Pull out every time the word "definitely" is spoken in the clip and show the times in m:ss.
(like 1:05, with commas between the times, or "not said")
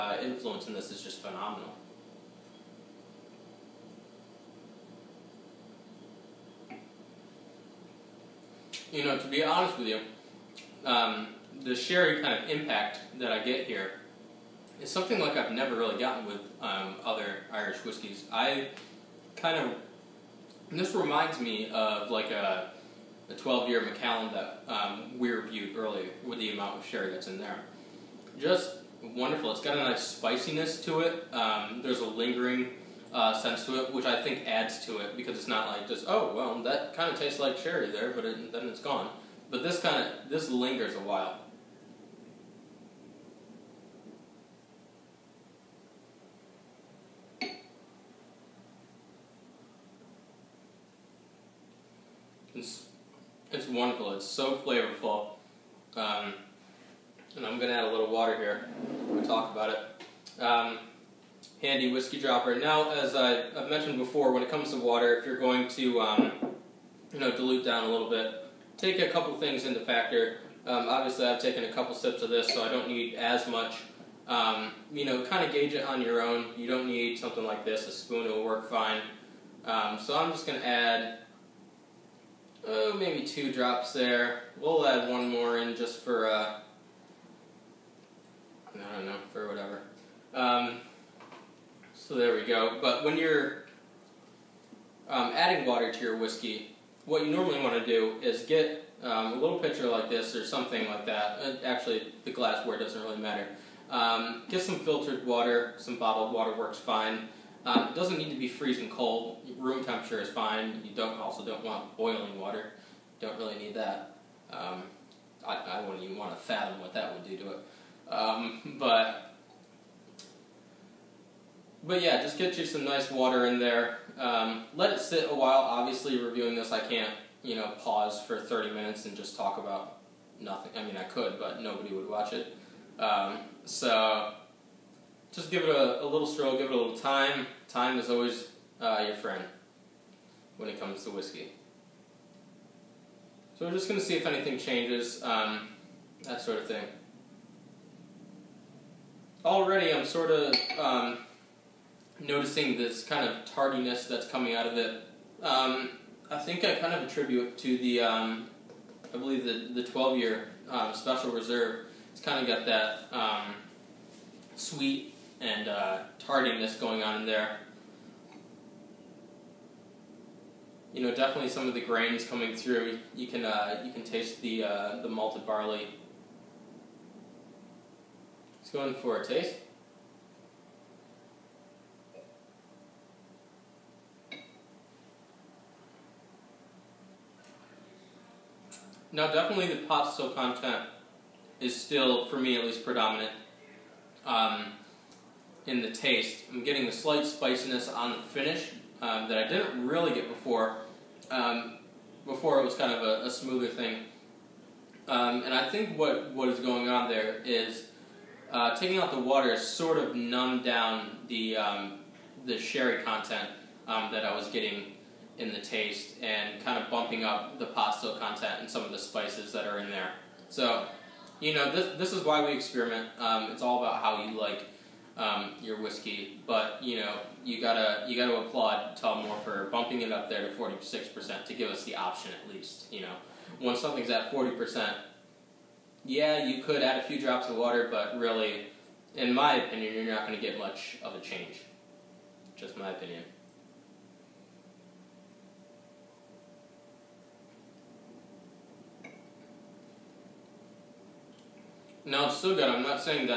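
2:51, 3:09.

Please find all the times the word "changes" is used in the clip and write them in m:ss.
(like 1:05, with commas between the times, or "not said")
2:24, 4:01.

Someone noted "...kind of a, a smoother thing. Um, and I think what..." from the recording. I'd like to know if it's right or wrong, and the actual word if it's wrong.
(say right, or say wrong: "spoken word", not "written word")
right.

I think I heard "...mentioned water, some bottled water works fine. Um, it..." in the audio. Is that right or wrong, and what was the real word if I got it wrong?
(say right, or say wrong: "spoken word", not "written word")
wrong: "filtered", not "mentioned".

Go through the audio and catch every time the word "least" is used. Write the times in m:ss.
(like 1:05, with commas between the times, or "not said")
3:12, 3:52.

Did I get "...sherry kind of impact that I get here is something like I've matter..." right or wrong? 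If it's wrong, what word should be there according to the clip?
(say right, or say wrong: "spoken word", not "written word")
wrong: "never", not "matter".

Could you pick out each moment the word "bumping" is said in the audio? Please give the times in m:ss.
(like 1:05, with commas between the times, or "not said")
3:36, 3:49.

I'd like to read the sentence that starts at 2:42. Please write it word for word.
It's kind of got that um, sweet and uh, tardiness going on in there.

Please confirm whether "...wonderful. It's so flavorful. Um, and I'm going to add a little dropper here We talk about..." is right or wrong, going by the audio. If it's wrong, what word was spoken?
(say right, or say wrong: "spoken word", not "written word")
wrong: "water", not "dropper".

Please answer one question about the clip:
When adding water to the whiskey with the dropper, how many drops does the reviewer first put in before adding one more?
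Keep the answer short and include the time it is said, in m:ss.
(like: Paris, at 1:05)
2, at 1:23.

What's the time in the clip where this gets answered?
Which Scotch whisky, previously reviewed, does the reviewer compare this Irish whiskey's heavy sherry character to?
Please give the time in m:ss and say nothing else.
0:23.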